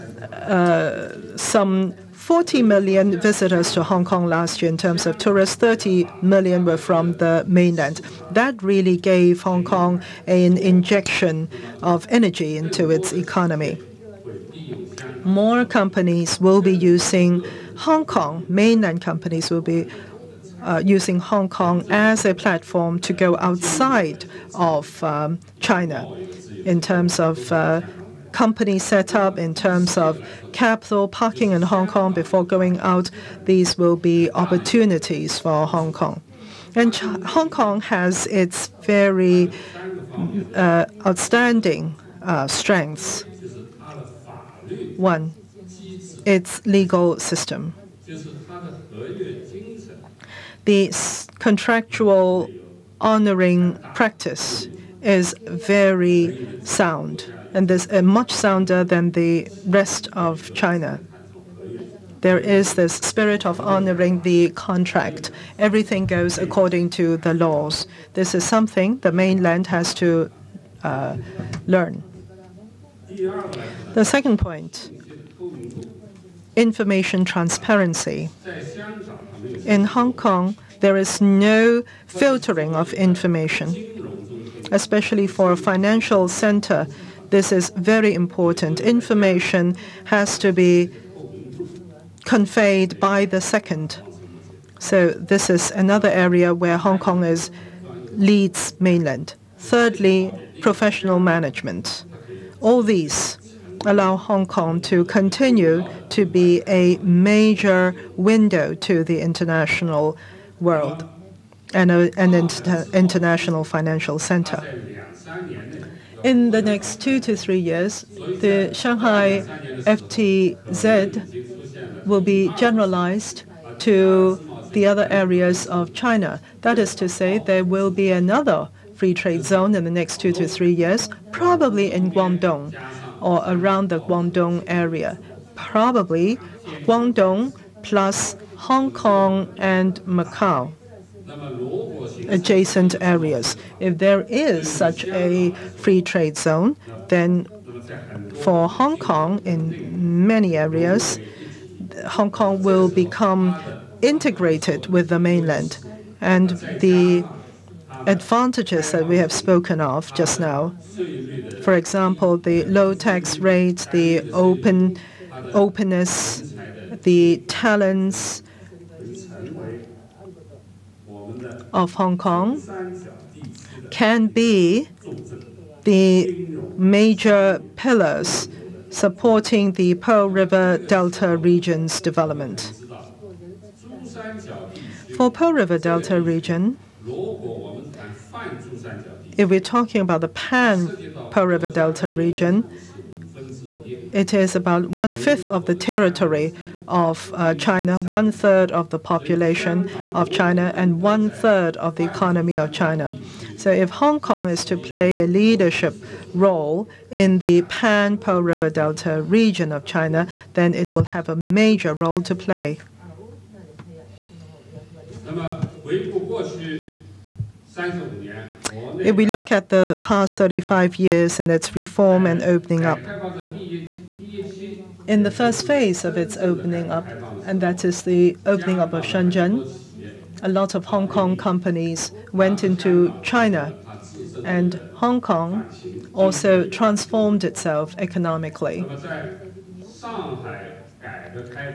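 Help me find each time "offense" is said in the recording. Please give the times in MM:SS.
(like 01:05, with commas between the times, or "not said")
not said.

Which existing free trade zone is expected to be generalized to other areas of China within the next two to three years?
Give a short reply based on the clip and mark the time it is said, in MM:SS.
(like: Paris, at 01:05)
Shanghai FTZ, at 01:58.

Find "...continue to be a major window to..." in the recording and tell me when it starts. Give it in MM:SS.
01:45.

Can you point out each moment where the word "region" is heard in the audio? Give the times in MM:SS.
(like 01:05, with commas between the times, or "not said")
03:01, 03:06, 03:12, 03:29.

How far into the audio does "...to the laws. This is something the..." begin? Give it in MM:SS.
01:06.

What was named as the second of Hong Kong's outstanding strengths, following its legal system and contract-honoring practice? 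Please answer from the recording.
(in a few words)
Information transparency.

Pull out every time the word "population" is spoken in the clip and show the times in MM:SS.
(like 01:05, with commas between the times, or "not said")
03:18.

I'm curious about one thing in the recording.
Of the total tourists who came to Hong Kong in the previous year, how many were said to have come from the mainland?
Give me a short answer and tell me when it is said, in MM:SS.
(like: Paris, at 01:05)
30 million, at 00:05.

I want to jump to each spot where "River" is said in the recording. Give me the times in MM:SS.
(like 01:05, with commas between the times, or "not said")
03:00, 03:05, 03:11, 03:28.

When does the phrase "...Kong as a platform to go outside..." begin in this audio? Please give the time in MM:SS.
00:21.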